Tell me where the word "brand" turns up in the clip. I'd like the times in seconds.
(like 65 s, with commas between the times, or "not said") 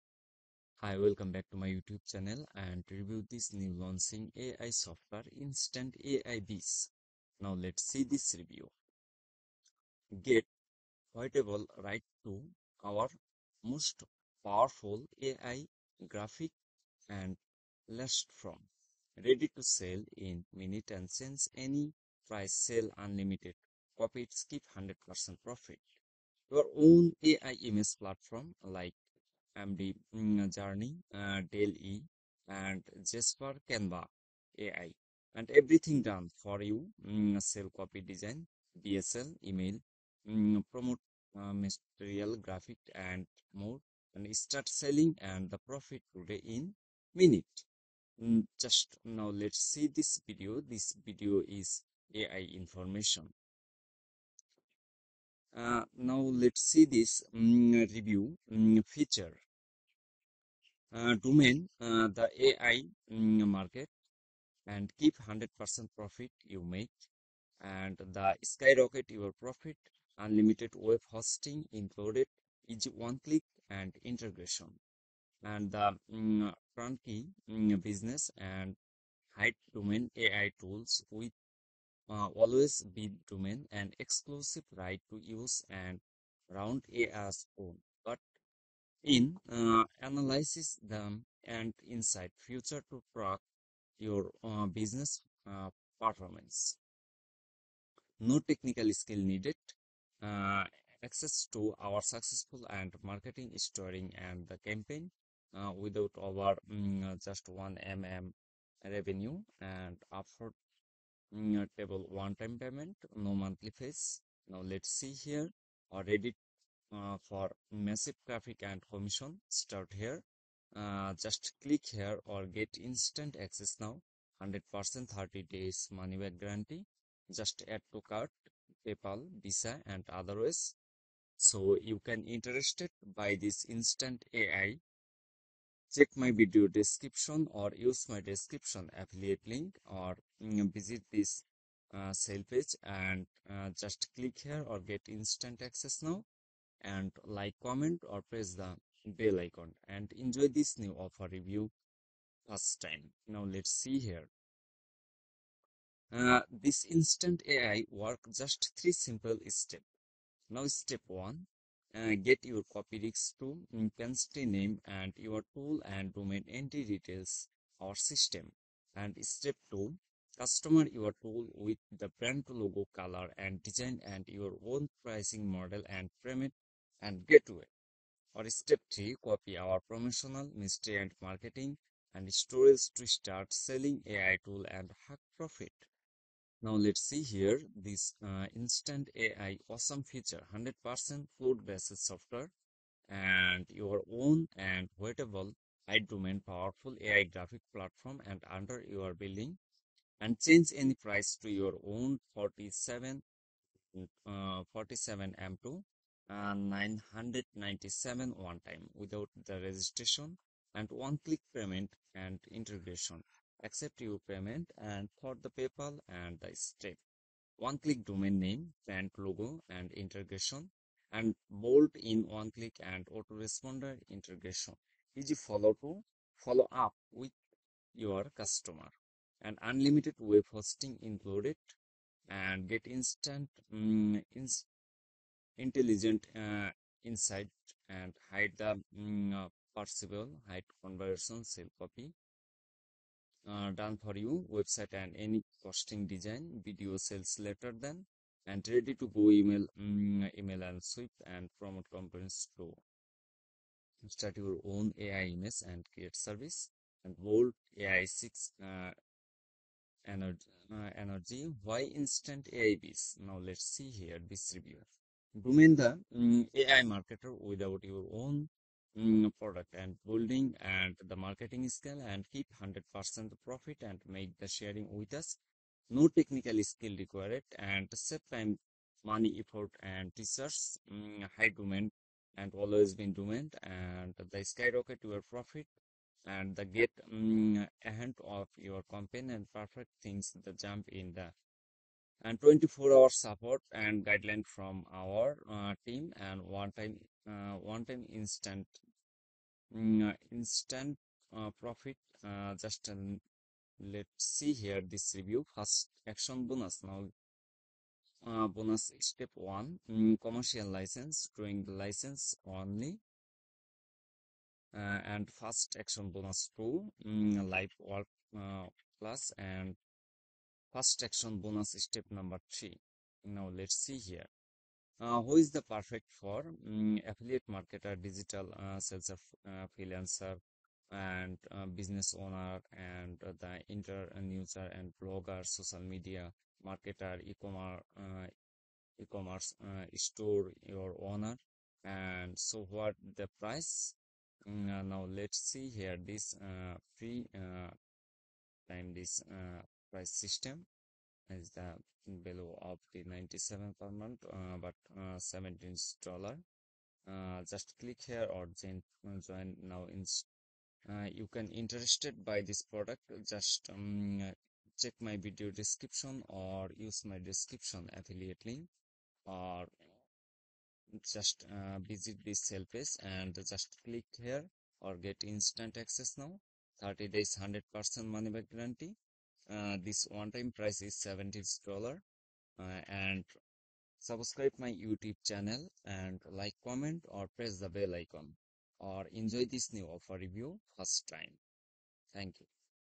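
172 s, 218 s.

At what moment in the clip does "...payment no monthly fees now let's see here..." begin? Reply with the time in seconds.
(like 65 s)
112 s.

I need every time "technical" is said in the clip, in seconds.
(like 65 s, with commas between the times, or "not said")
98 s, 276 s.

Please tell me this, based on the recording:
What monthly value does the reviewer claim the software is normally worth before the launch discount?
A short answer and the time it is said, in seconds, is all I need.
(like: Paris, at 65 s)
$97 per month, at 353 s.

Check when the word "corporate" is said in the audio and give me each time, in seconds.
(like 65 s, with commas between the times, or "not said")
not said.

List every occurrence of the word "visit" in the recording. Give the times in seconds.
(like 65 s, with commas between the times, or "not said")
140 s, 371 s.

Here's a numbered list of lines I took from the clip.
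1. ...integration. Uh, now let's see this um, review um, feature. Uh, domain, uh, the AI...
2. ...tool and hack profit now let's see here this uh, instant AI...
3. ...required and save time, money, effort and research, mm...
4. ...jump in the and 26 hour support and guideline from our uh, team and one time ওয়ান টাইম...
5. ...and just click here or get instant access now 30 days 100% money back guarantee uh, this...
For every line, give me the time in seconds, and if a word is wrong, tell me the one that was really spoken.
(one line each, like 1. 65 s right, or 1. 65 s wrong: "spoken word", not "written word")
1. 52 s wrong: "information", not "integration"
2. 184 s right
3. 276 s right
4. 290 s wrong: "24", not "26"
5. 373 s right.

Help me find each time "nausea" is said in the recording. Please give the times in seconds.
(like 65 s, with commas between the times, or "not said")
not said.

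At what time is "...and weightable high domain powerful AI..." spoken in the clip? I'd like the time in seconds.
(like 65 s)
194 s.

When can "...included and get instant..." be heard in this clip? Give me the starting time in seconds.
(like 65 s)
231 s.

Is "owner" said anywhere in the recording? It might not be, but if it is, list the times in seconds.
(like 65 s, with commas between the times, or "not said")
332 s, 341 s.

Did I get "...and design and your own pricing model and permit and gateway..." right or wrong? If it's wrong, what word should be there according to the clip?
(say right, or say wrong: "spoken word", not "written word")
right.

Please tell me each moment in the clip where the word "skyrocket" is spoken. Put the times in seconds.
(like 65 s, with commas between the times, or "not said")
68 s, 284 s.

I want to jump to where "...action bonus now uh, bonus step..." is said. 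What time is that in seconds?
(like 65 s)
306 s.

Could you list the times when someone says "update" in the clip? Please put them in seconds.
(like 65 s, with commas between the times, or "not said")
not said.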